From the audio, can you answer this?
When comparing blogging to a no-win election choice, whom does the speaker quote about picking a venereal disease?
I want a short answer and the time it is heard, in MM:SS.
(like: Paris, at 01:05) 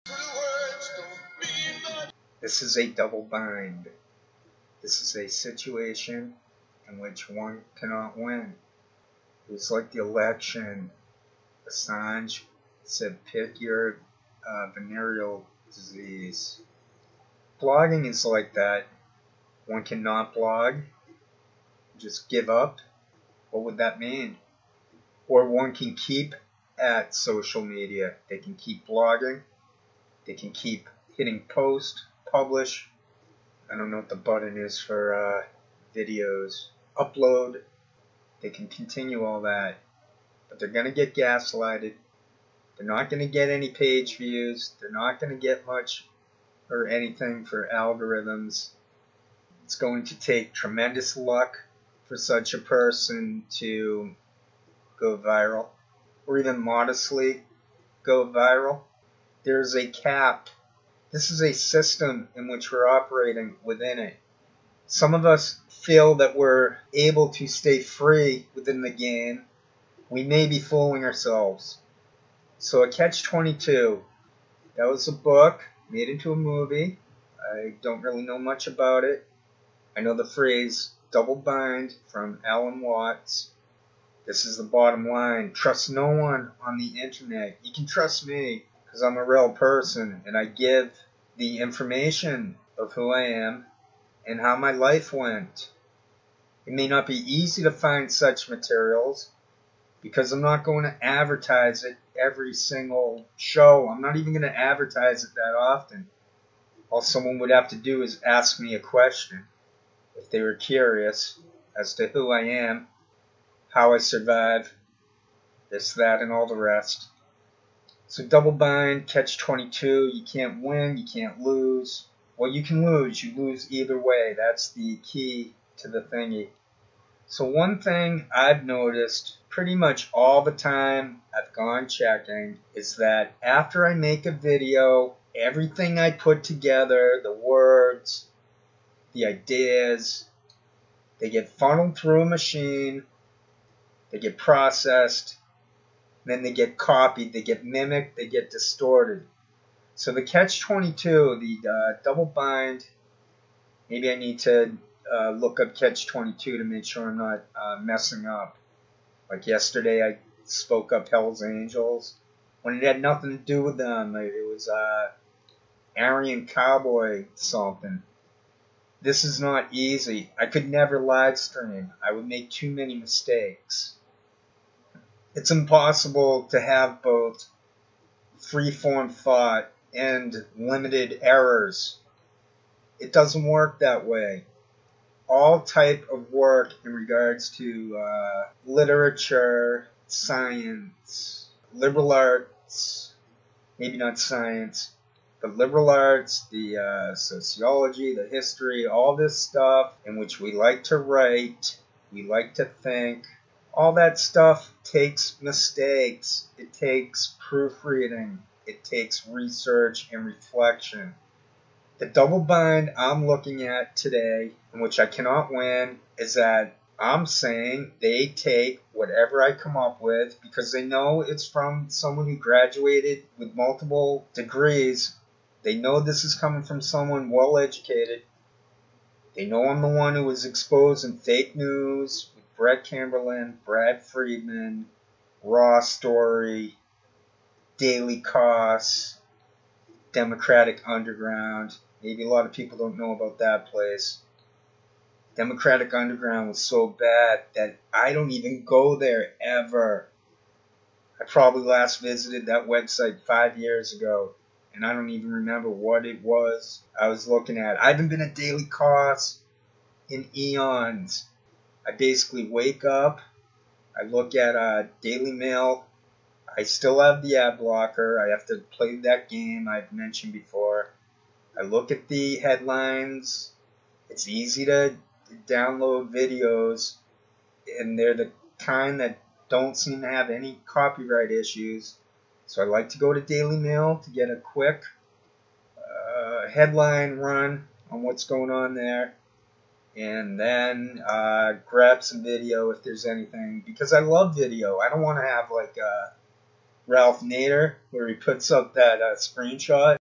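Assange, at 00:11.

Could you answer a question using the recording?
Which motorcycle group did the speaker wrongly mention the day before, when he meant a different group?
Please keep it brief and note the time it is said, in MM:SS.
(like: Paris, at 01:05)
Hell's Angels, at 02:41.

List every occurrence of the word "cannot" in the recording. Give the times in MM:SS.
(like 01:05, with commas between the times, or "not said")
00:07, 00:19, 03:35.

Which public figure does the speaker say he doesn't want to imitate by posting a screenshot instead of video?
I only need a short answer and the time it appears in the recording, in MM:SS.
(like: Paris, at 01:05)
Ralph Nader, at 04:56.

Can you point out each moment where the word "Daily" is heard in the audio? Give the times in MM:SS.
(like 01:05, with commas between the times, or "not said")
03:57, 04:18, 04:25, 04:43.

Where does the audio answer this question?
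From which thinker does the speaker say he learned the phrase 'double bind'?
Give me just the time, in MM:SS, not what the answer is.
01:22.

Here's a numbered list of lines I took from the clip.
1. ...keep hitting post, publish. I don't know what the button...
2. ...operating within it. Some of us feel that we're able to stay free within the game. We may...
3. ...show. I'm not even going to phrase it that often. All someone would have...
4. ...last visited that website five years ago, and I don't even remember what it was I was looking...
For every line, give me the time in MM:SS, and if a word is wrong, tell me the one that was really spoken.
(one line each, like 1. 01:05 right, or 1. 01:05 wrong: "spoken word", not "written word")
1. 00:30 right
2. 01:02 right
3. 01:43 wrong: "advertise", not "phrase"
4. 04:11 right.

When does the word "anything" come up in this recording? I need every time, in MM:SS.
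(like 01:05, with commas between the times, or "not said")
00:46, 04:53.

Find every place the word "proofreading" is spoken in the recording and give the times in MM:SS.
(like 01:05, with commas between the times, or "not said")
03:27.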